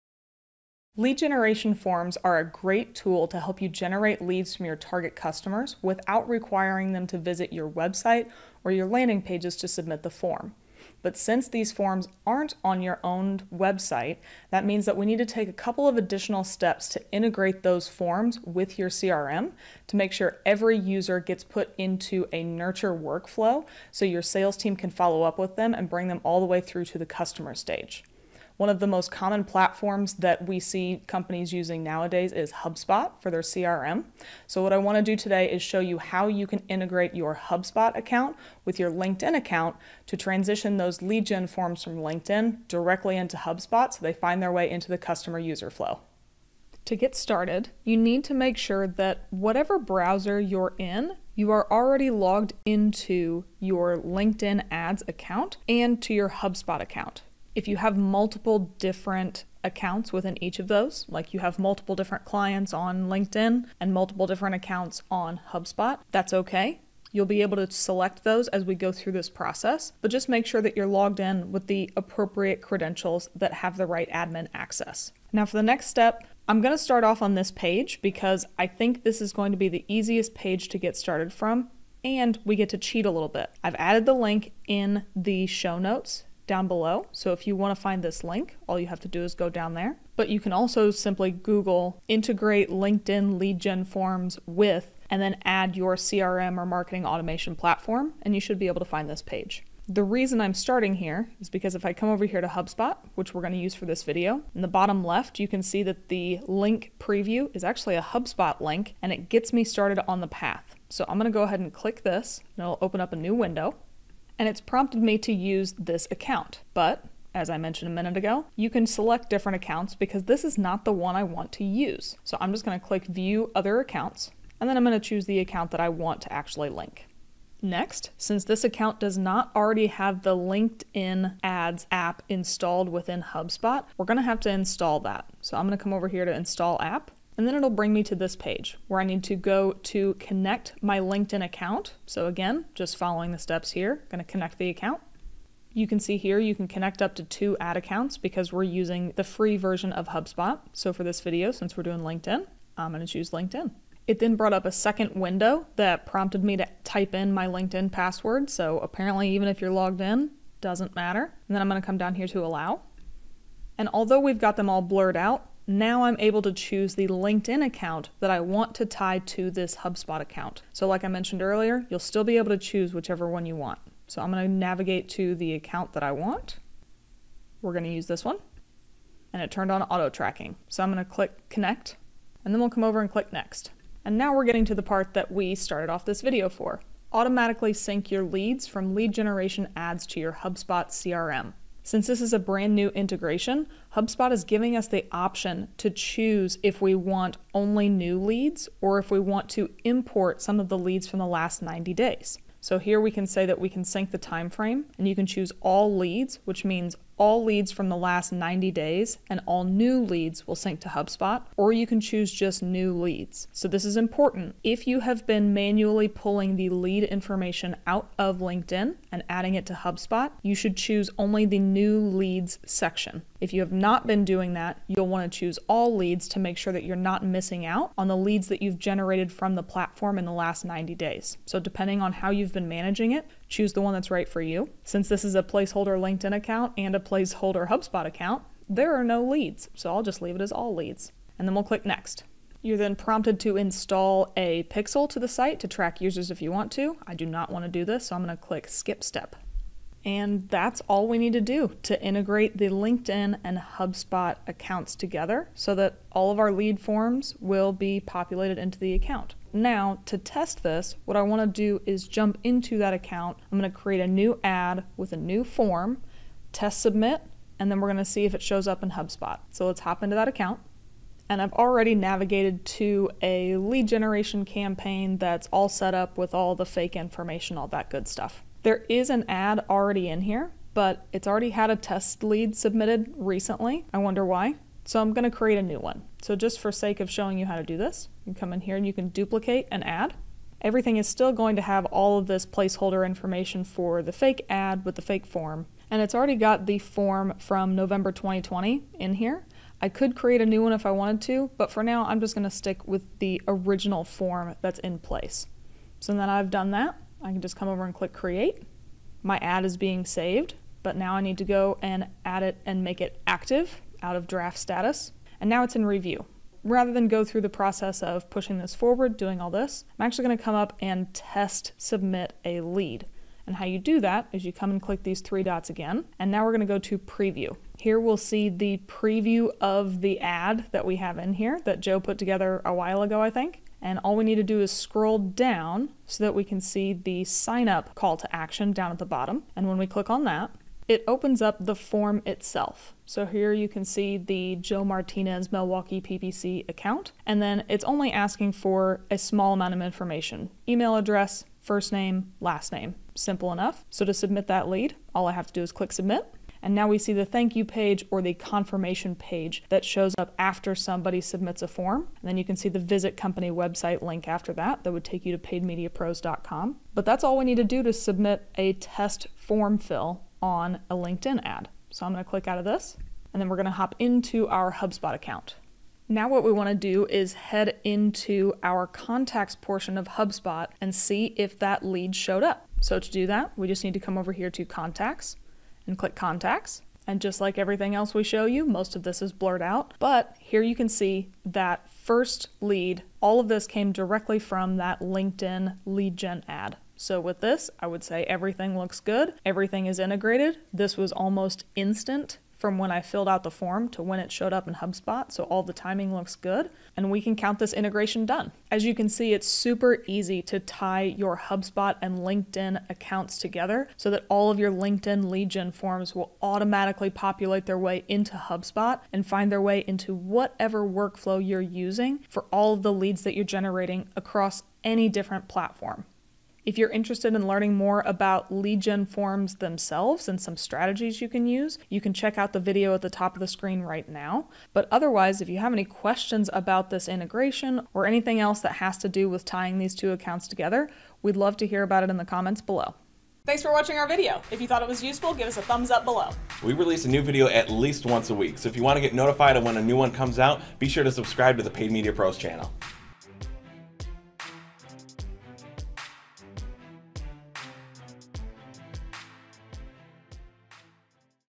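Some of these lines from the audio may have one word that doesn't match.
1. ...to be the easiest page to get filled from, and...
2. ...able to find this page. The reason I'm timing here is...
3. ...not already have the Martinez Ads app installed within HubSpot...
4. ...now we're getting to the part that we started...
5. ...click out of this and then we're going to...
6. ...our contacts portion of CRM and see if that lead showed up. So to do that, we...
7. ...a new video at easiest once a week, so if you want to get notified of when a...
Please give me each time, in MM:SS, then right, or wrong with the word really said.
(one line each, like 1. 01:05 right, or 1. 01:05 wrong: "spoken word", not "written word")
1. 01:19 wrong: "started", not "filled"
2. 01:38 wrong: "starting", not "timing"
3. 02:09 wrong: "LinkedIn", not "Martinez"
4. 03:04 right
5. 06:12 right
6. 06:18 wrong: "HubSpot", not "CRM"
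7. 07:27 wrong: "least", not "easiest".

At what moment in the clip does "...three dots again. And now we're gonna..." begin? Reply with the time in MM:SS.
05:25.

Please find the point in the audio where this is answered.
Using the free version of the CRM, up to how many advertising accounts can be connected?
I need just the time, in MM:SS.
02:27.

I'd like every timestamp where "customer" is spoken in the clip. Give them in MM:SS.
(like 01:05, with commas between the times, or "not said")
00:05, 00:27, 00:44.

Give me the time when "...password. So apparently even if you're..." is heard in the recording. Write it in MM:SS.
02:37.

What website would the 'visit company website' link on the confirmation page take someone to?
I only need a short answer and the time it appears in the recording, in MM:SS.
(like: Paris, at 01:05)
paidmediapros.com, at 06:05.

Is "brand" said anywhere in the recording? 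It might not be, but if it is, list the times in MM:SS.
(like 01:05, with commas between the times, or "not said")
03:12.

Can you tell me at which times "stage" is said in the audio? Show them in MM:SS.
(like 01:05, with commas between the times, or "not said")
00:27.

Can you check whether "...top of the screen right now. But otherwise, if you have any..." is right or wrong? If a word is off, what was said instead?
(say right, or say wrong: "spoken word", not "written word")
right.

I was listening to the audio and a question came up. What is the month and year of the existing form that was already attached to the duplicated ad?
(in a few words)
November 2020.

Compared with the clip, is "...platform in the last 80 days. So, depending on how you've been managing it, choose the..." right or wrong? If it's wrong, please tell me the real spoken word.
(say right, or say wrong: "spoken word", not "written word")
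wrong: "90", not "80".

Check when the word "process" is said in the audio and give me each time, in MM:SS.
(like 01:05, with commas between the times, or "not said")
01:09, 05:17.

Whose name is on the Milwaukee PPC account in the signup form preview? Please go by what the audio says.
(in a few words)
Joe Martinez.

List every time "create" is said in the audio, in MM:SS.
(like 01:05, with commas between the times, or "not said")
04:23, 04:45, 05:00, 05:08.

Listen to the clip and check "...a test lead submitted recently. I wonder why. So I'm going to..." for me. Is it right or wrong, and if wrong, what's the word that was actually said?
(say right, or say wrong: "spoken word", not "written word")
right.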